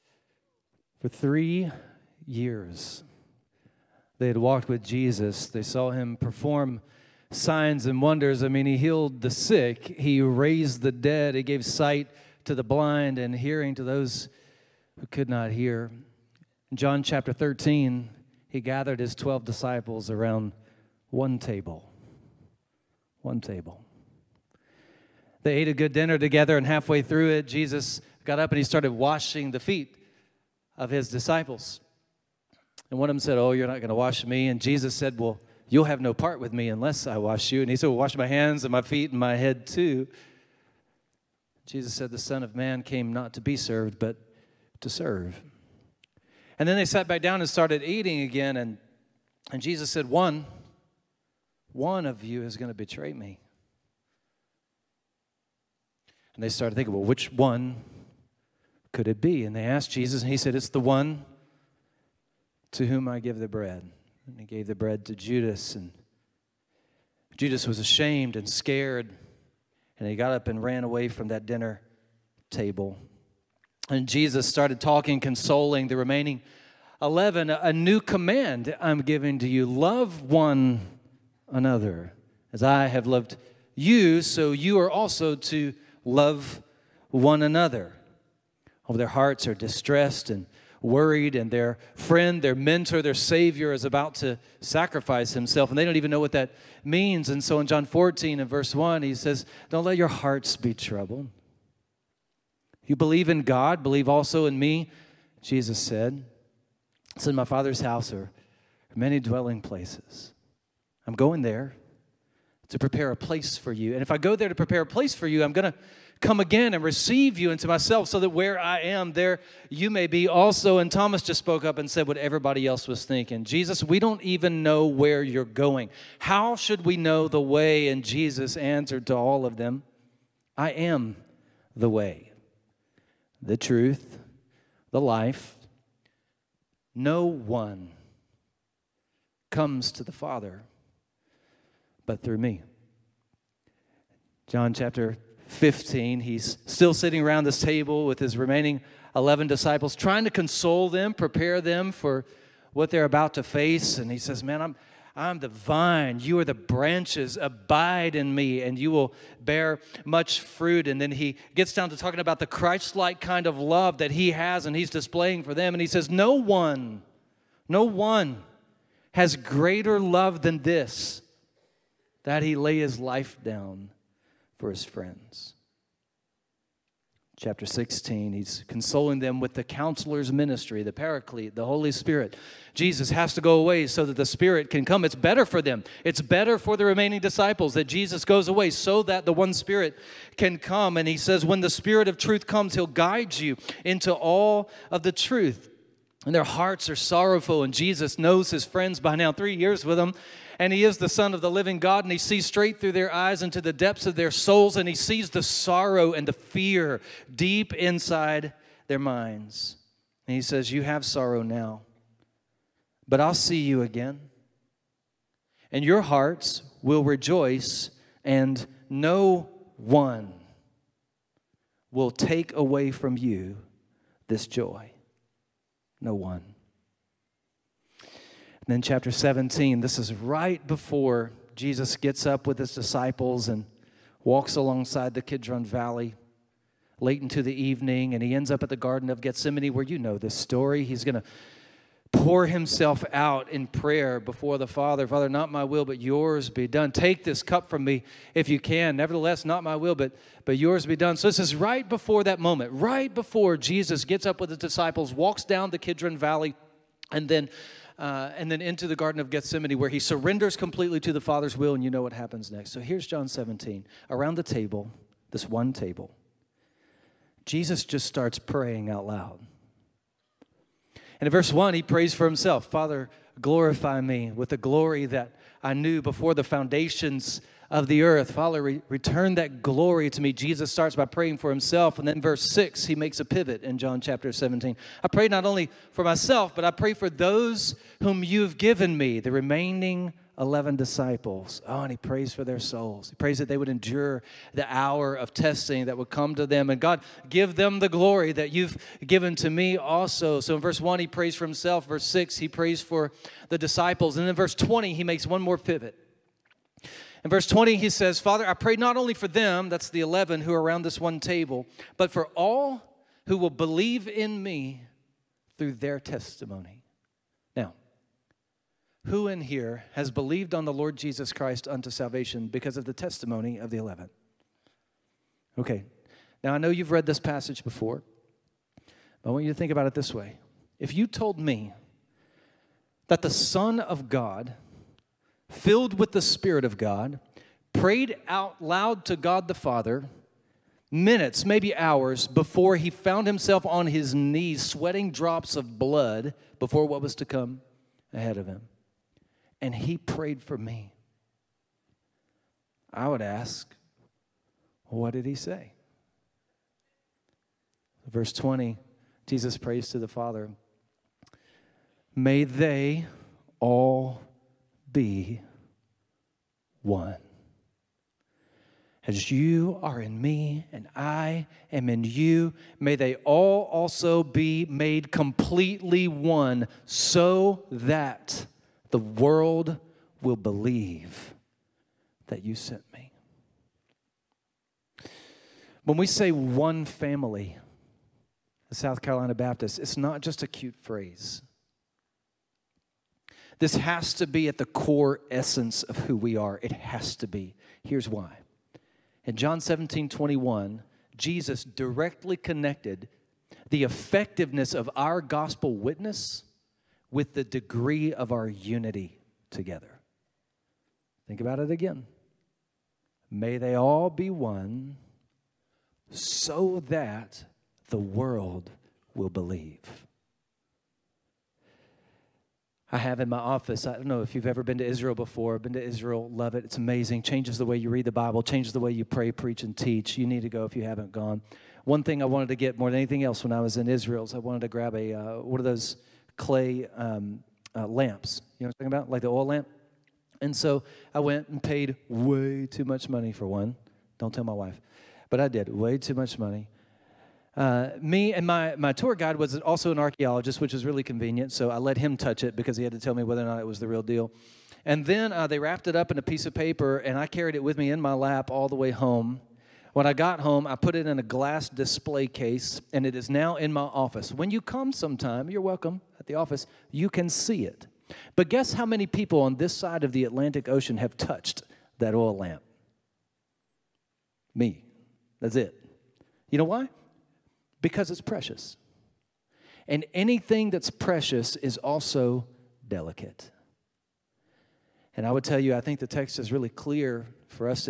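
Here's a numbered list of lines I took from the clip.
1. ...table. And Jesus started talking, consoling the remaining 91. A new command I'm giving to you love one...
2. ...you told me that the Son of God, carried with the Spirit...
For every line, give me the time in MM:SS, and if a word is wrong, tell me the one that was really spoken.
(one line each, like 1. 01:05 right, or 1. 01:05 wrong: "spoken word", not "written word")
1. 01:12 wrong: "11", not "91"
2. 05:30 wrong: "filled", not "carried".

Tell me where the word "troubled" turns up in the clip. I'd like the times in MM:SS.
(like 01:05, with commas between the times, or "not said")
01:40.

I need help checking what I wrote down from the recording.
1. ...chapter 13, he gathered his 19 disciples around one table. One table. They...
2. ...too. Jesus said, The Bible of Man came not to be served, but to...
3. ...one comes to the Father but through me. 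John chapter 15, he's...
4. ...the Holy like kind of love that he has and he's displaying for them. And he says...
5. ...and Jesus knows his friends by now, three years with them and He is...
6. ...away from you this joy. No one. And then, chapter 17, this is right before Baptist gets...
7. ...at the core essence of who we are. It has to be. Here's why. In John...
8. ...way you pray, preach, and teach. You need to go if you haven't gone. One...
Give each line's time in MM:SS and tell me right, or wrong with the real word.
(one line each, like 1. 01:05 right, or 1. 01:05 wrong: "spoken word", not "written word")
1. 00:17 wrong: "12", not "19"
2. 00:39 wrong: "Son", not "Bible"
3. 02:17 right
4. 02:42 wrong: "Christ", not "Holy"
5. 03:17 right
6. 03:42 wrong: "Jesus", not "Baptist"
7. 06:34 right
8. 07:08 right.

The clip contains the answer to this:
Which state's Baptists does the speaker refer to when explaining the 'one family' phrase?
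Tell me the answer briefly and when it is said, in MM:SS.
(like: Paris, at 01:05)
South Carolina, at 06:28.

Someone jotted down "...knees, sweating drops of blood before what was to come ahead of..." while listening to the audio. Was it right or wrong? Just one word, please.
right.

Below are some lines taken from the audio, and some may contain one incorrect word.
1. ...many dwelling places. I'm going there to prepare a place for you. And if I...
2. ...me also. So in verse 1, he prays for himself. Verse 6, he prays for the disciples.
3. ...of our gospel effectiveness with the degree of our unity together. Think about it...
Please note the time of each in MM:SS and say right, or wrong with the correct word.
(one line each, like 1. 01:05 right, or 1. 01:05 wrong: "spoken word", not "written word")
1. 01:48 right
2. 04:59 right
3. 06:44 wrong: "witness", not "effectiveness".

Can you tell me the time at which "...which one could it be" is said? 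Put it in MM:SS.
00:57.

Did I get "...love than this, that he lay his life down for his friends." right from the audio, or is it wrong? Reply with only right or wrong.
right.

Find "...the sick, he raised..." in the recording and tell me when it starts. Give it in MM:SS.
00:09.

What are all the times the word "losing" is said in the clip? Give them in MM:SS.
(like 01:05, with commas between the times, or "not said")
not said.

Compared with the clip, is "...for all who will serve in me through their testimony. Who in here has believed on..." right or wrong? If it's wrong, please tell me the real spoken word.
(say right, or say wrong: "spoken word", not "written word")
wrong: "believe", not "serve".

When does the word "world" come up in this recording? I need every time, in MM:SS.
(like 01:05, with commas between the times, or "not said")
06:19, 06:57.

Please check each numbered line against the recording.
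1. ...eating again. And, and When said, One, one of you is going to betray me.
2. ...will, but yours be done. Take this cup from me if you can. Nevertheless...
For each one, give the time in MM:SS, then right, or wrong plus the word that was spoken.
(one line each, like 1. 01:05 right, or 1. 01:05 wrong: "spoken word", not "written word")
1. 00:47 wrong: "Jesus", not "When"
2. 04:05 right.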